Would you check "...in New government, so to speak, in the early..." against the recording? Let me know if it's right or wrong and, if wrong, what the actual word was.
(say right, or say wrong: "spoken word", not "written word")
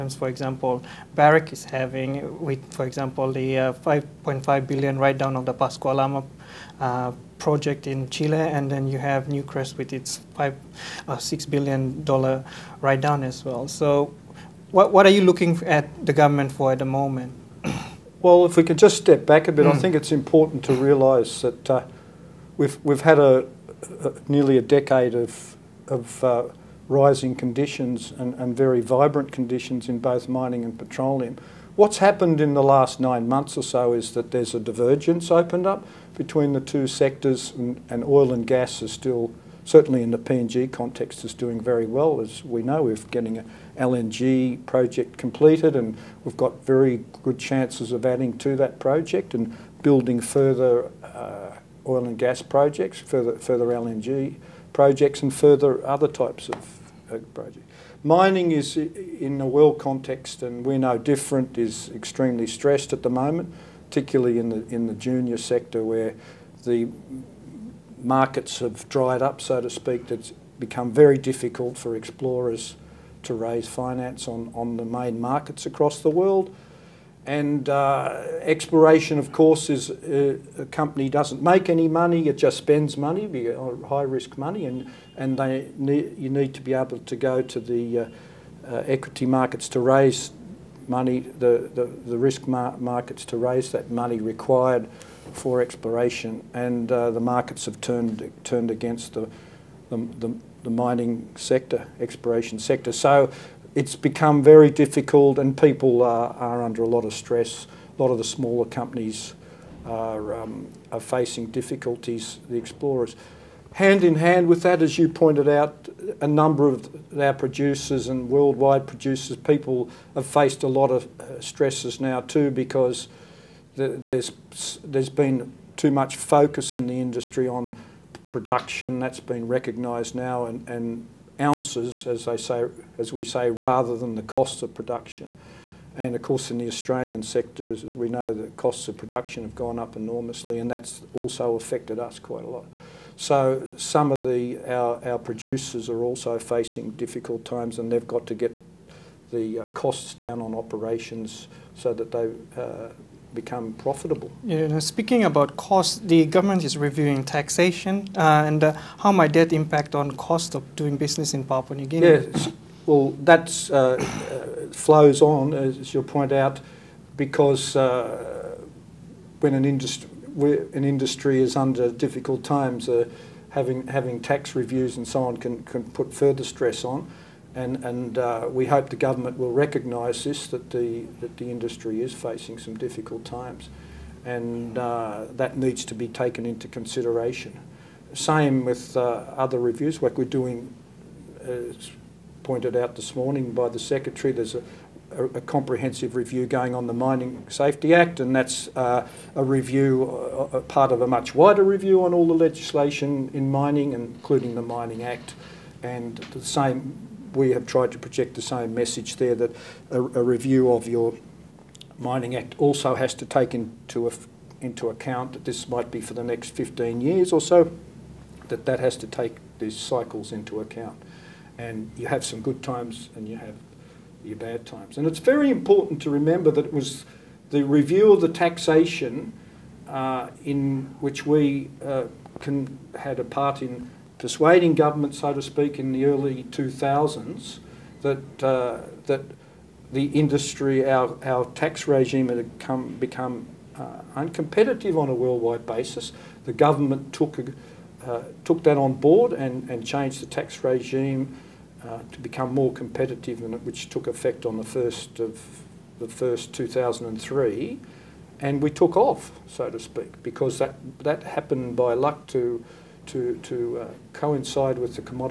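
wrong: "Persuading", not "New".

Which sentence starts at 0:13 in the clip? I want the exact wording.
So, what what are you looking at the government for at the moment?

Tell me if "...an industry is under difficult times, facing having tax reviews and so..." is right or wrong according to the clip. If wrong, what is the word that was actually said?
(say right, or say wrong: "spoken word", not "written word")
wrong: "having", not "facing".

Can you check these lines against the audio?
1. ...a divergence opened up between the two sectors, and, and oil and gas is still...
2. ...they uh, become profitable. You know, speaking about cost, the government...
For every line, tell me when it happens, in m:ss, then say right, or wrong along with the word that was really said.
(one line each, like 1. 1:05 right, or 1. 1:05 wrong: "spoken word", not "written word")
1. 0:34 right
2. 2:32 right.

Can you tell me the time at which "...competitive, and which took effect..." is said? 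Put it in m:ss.
4:12.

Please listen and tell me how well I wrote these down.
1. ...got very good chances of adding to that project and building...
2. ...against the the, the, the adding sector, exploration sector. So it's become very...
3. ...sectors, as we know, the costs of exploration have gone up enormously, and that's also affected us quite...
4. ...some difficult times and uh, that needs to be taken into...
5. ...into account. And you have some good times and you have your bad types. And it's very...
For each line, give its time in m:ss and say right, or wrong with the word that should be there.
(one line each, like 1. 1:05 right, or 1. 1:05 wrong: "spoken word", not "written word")
1. 0:46 right
2. 1:38 wrong: "mining", not "adding"
3. 2:17 wrong: "production", not "exploration"
4. 3:02 right
5. 3:40 wrong: "times", not "types".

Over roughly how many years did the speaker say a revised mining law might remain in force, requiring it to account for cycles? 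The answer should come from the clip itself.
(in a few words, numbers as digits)
15 years.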